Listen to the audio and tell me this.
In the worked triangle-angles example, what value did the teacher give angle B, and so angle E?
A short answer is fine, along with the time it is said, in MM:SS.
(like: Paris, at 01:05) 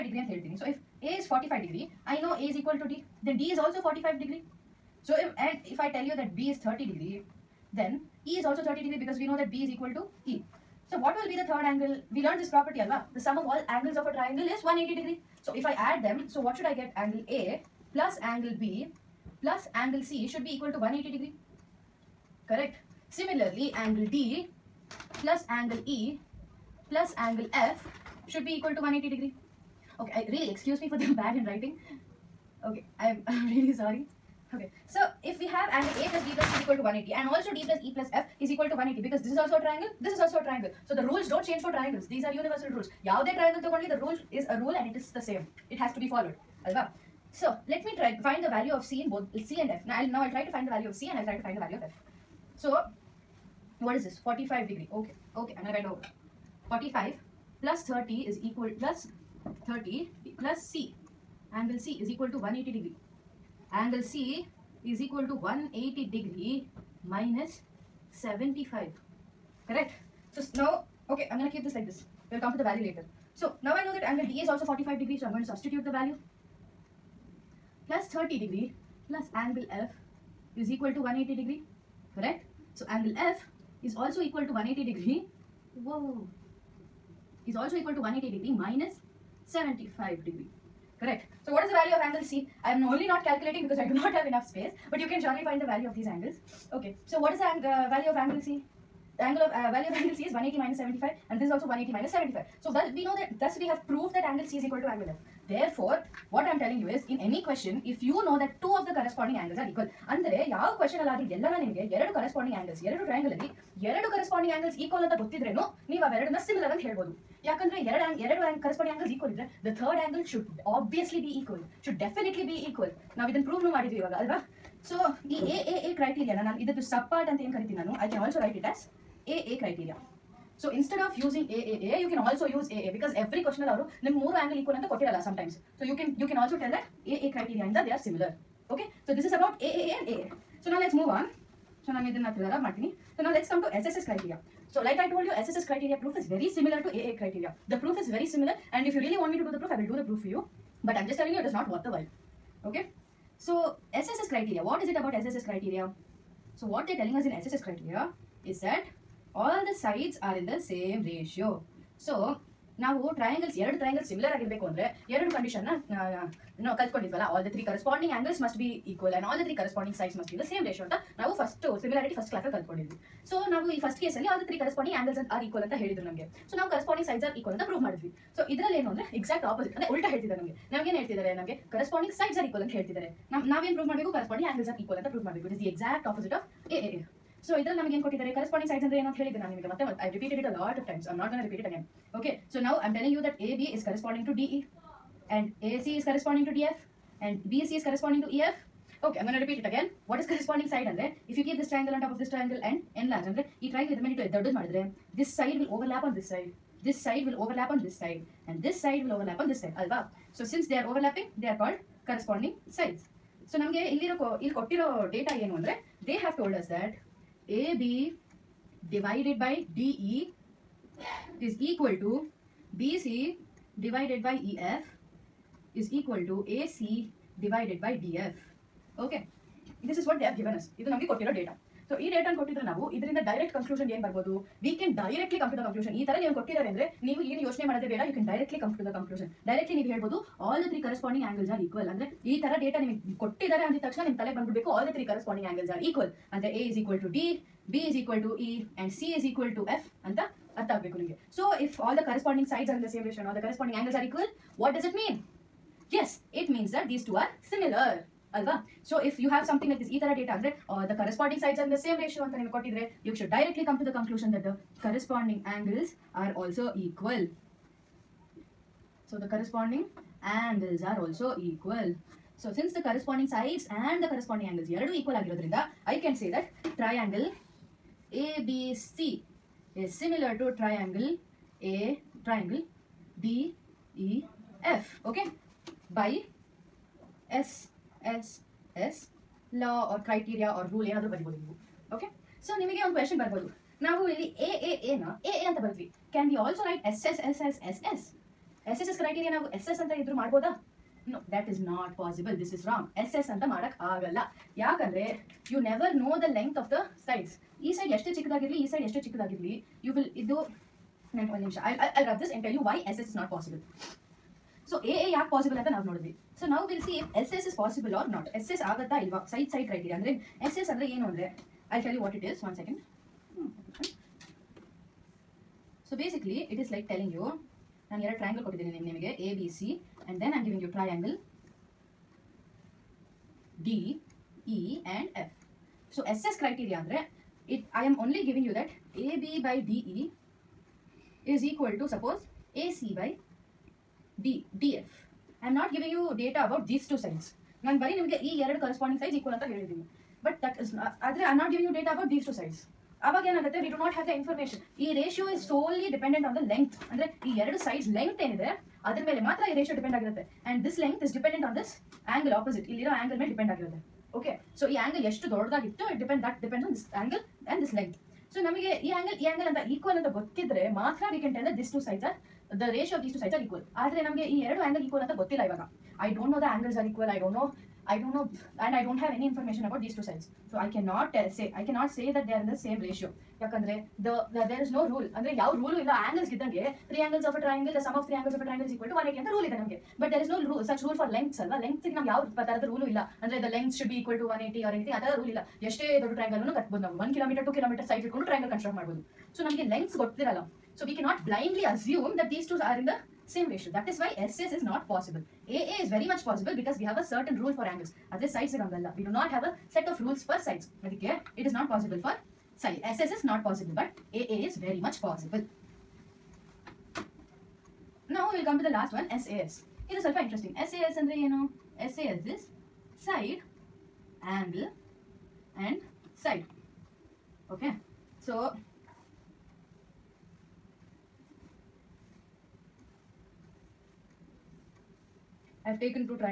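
30 degrees, at 00:06.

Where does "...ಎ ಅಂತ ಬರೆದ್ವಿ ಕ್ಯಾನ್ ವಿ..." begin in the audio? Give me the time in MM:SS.
04:55.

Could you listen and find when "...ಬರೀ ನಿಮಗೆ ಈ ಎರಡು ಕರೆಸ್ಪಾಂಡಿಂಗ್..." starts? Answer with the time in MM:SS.
05:47.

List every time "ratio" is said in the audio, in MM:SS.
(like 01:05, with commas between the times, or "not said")
02:41, 04:13, 04:22, 06:43.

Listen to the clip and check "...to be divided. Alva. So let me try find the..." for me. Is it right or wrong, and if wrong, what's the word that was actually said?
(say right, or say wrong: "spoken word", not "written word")
wrong: "followed", not "divided".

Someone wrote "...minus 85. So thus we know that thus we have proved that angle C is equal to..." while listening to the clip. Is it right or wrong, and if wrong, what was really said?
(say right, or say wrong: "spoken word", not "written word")
wrong: "75", not "85".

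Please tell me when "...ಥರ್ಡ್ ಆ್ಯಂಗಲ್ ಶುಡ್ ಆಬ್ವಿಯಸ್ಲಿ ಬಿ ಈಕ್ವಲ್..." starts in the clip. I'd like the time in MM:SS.
01:59.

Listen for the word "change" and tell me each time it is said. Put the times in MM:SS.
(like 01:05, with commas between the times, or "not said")
00:41.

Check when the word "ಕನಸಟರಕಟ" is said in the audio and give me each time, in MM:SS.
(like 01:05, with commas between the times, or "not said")
06:38.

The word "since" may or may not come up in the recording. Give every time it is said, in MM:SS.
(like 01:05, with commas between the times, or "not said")
03:30, 04:32.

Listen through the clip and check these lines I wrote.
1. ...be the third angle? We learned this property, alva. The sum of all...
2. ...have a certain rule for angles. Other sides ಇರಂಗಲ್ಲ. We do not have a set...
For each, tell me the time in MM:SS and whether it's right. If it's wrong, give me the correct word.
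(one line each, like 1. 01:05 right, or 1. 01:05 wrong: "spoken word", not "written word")
1. 00:11 right
2. 06:46 right.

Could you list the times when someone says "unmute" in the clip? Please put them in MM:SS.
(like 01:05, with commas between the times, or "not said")
not said.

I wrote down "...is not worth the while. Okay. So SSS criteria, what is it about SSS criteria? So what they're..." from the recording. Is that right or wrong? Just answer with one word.
right.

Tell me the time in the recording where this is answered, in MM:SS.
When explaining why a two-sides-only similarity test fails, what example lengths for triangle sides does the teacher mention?
06:37.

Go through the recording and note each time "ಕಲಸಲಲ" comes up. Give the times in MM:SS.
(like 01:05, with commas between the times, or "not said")
02:52.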